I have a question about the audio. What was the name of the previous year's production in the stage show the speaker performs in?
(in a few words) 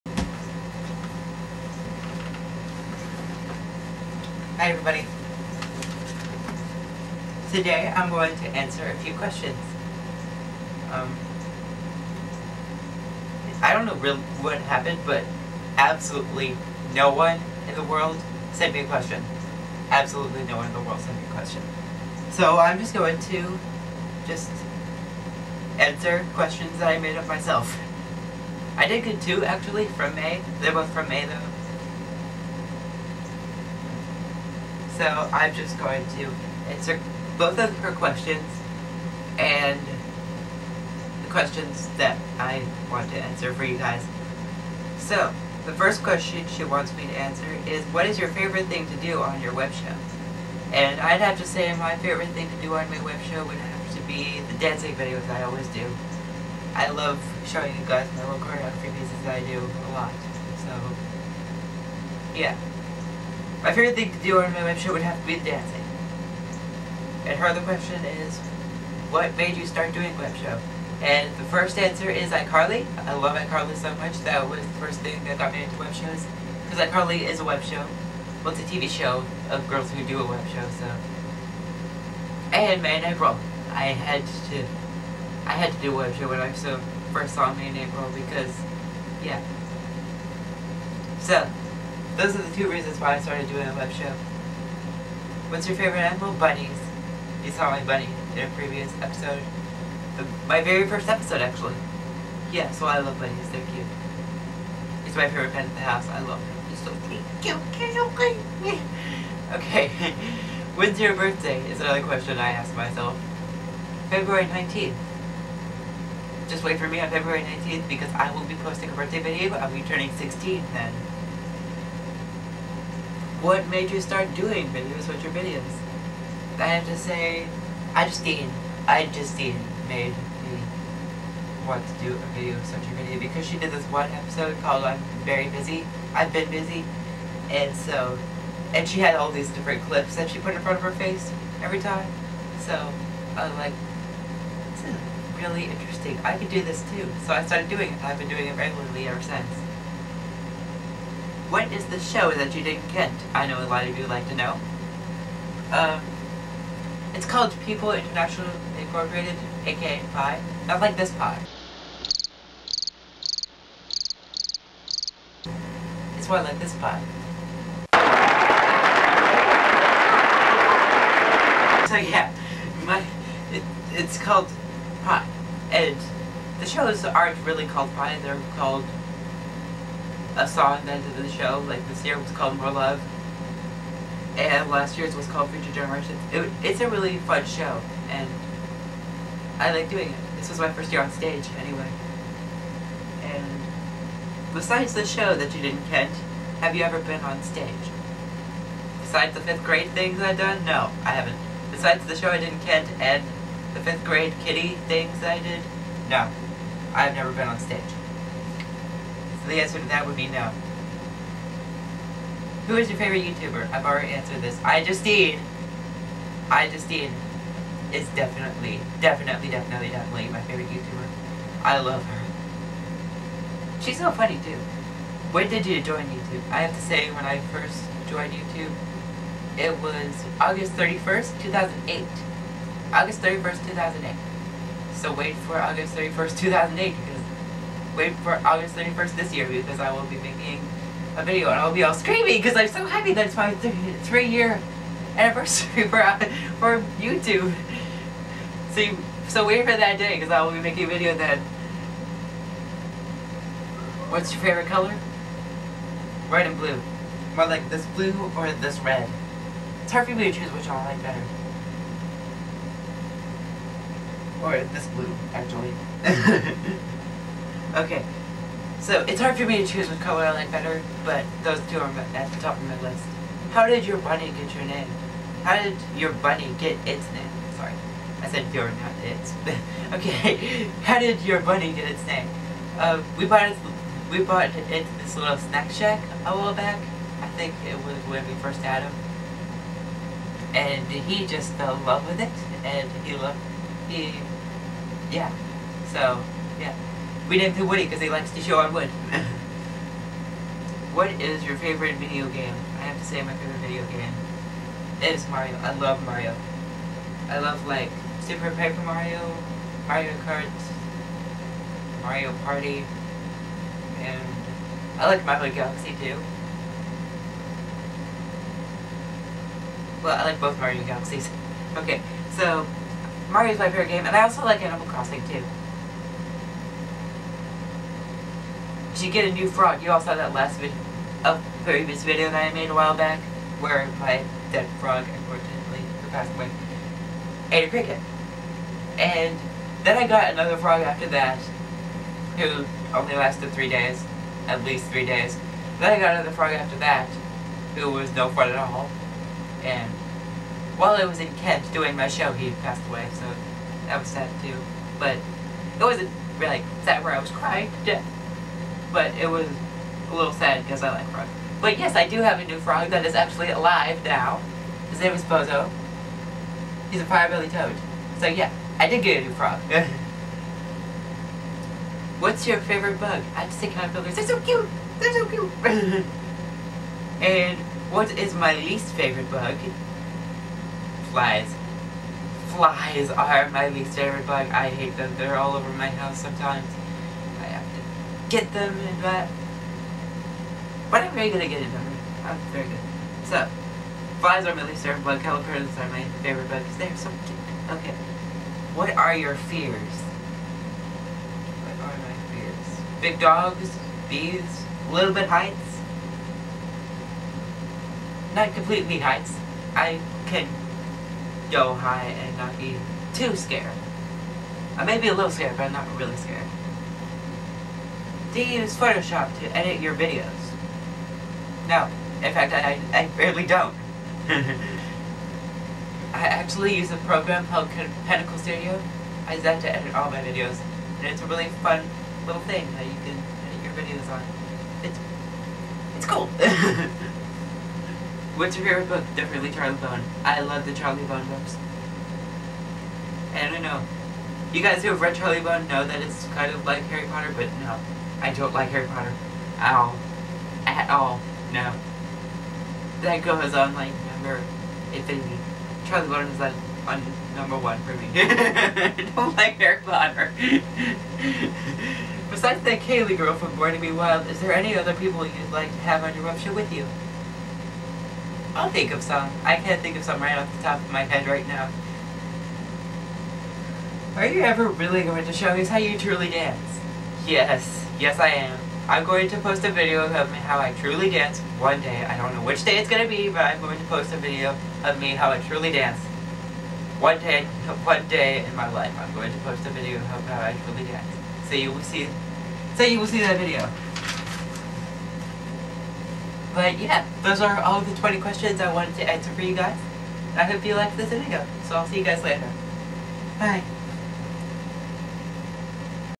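Future Generations.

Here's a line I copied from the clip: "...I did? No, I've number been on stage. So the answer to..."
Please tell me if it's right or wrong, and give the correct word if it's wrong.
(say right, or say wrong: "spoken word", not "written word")
wrong: "never", not "number".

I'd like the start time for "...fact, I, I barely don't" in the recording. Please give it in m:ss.
7:02.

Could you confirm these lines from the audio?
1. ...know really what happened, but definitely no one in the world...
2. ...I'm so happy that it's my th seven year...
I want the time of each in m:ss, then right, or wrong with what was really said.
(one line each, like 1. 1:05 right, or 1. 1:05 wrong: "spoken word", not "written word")
1. 0:13 wrong: "absolutely", not "definitely"
2. 4:02 wrong: "three", not "seven".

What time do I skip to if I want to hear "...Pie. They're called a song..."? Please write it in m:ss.
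2:57.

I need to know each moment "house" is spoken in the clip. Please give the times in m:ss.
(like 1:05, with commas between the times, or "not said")
1:45, 6:25.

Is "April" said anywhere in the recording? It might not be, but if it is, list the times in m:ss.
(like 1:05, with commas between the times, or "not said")
1:23, 1:27.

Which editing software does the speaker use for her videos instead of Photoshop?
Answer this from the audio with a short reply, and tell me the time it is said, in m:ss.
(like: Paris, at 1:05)
Pinnacle Studio, at 7:08.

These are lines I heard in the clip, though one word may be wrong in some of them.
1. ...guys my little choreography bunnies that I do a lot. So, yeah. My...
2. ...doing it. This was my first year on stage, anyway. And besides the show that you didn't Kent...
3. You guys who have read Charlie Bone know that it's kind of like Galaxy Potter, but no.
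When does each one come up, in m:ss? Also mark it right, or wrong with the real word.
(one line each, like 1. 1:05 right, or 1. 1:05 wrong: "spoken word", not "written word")
1. 0:57 wrong: "pieces", not "bunnies"
2. 3:09 right
3. 7:24 wrong: "Harry", not "Galaxy".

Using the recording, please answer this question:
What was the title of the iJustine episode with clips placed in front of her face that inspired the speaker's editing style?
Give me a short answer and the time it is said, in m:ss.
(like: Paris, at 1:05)
I'm Very Busy, at 2:14.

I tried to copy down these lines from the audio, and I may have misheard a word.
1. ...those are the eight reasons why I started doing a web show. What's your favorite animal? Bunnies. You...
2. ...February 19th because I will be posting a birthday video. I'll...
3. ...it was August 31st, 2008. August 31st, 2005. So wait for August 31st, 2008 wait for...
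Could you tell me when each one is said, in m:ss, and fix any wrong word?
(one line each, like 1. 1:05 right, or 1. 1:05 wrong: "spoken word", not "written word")
1. 1:32 wrong: "two", not "eight"
2. 1:57 right
3. 3:49 wrong: "2008", not "2005".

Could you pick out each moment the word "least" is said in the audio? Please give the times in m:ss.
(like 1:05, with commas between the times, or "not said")
5:44, 6:18, 6:23, 6:34.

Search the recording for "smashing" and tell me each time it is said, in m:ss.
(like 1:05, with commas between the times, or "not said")
not said.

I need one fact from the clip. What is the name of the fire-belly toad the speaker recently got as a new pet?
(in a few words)
Bozo.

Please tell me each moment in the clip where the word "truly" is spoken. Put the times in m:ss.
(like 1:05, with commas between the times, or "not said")
7:55, 8:00, 8:05, 8:10.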